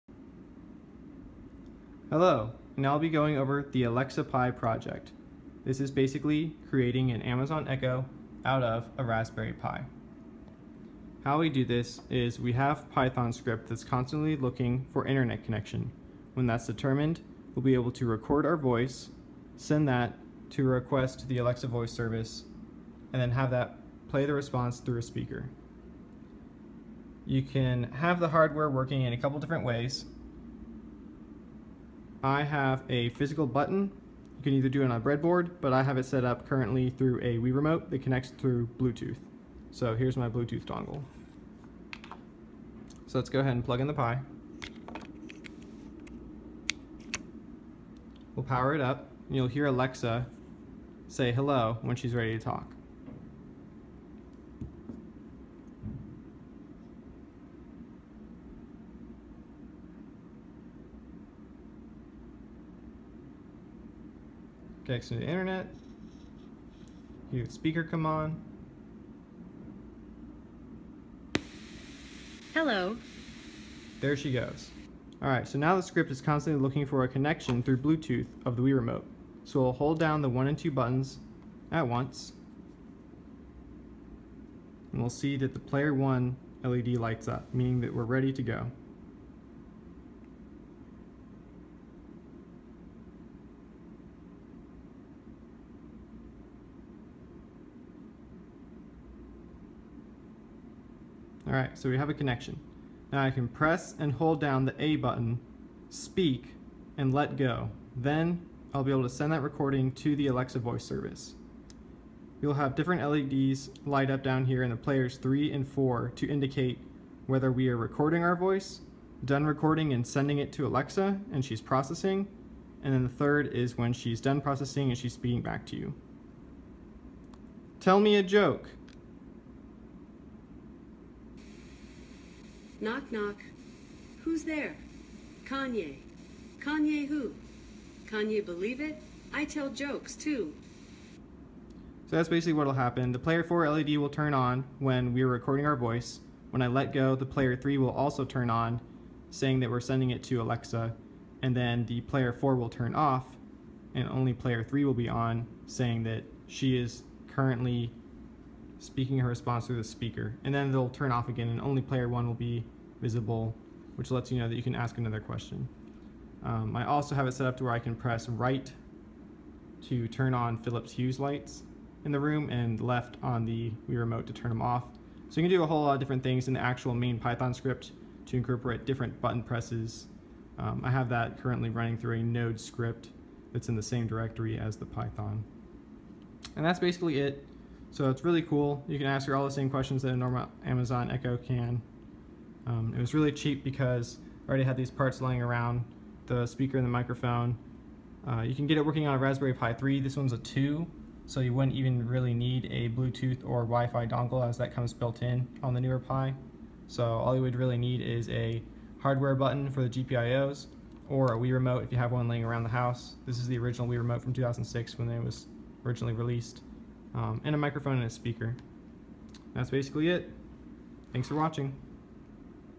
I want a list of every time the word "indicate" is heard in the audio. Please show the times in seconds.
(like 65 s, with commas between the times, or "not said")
116 s.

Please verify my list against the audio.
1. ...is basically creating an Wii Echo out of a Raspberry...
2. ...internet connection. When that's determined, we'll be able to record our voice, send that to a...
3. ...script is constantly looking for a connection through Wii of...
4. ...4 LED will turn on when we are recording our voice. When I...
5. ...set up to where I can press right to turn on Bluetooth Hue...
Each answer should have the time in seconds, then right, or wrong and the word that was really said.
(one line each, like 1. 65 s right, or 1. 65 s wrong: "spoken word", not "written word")
1. 5 s wrong: "Amazon", not "Wii"
2. 15 s right
3. 75 s wrong: "Bluetooth", not "Wii"
4. 143 s right
5. 167 s wrong: "Philips", not "Bluetooth".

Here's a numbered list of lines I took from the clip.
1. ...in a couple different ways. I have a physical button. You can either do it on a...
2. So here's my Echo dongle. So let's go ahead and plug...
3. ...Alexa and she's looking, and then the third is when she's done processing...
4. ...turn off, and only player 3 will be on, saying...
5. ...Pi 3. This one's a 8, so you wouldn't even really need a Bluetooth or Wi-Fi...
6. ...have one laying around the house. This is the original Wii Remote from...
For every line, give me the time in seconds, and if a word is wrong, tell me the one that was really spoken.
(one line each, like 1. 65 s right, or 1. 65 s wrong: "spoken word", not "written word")
1. 29 s right
2. 39 s wrong: "Bluetooth", not "Echo"
3. 120 s wrong: "processing", not "looking"
4. 152 s right
5. 199 s wrong: "2", not "8"
6. 211 s right.